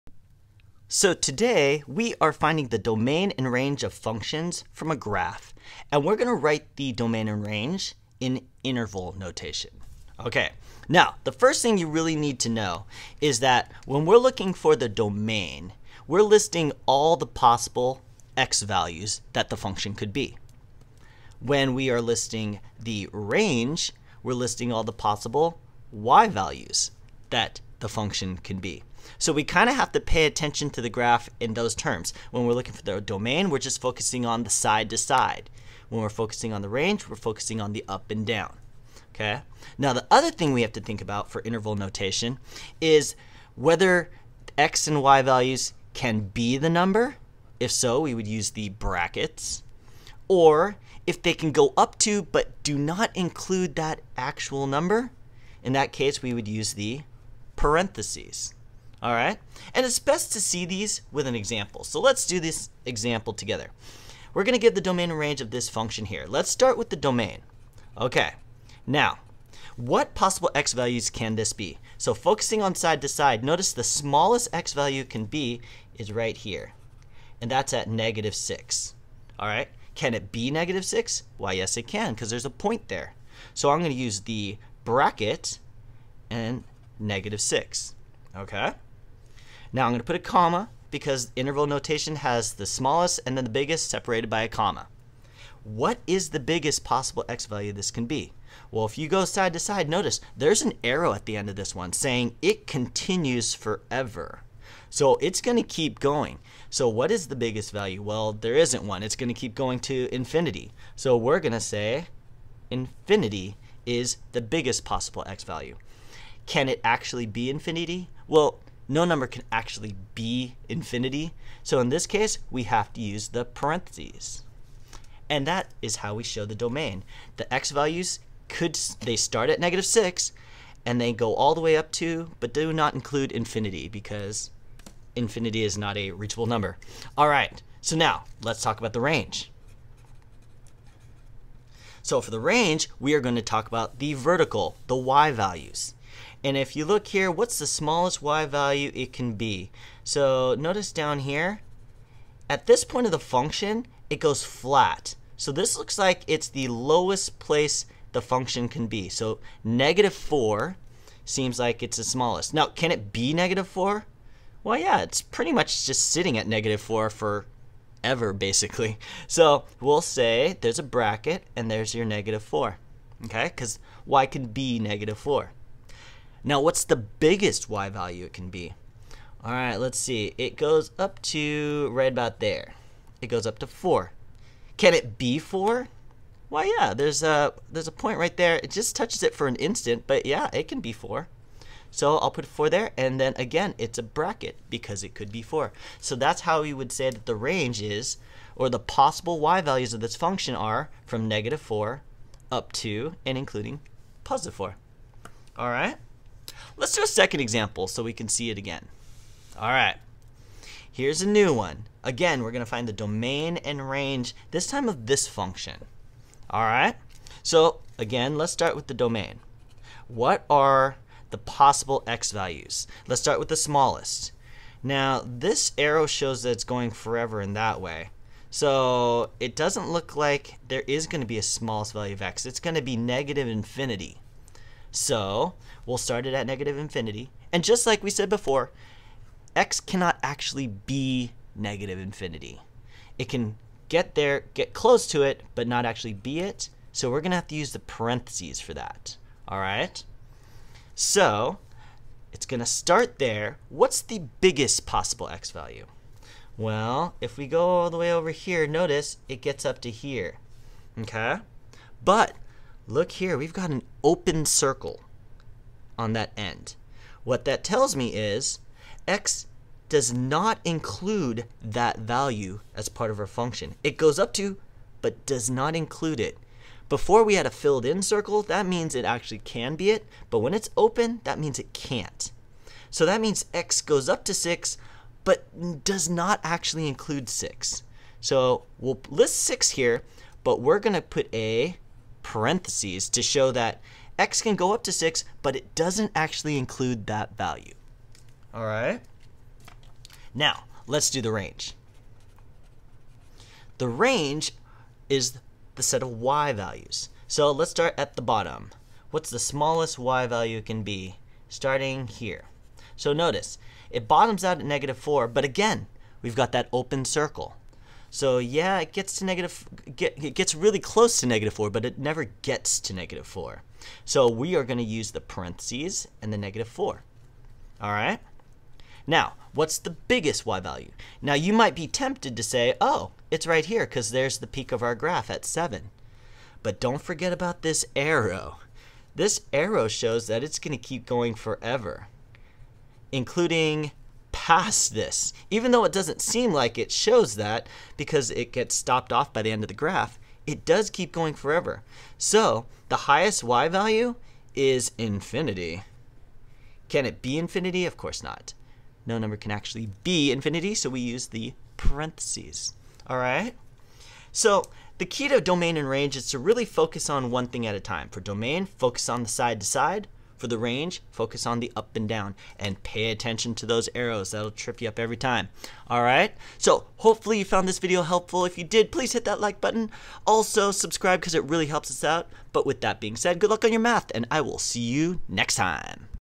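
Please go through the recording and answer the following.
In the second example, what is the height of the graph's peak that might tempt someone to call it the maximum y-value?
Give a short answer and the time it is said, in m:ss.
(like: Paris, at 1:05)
7, at 5:35.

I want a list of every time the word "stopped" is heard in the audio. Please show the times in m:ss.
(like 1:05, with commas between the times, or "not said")
5:48.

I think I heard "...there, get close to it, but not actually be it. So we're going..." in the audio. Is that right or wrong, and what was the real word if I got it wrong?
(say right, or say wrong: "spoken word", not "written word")
right.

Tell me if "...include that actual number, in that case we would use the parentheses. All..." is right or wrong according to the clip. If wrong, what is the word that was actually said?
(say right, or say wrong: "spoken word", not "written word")
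right.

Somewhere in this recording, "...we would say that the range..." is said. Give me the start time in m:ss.
3:16.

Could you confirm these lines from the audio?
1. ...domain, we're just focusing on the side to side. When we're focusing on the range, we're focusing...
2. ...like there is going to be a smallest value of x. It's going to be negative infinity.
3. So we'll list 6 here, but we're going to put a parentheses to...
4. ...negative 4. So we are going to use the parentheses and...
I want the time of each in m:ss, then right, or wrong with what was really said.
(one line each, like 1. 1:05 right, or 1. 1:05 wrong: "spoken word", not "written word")
1. 0:33 right
2. 3:50 right
3. 4:48 right
4. 5:22 right.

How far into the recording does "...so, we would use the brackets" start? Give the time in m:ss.
0:47.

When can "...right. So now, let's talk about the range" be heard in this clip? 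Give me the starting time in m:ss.
2:17.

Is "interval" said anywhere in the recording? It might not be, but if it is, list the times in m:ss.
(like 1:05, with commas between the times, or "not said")
0:08, 0:41, 1:31.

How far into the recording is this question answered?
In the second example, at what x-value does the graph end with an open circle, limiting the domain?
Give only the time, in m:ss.
4:43.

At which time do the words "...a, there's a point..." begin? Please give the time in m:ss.
3:07.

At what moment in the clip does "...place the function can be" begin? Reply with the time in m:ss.
2:37.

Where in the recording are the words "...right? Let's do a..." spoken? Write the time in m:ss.
3:25.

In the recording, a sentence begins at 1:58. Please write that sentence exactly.
Well, no number can actually be infinity.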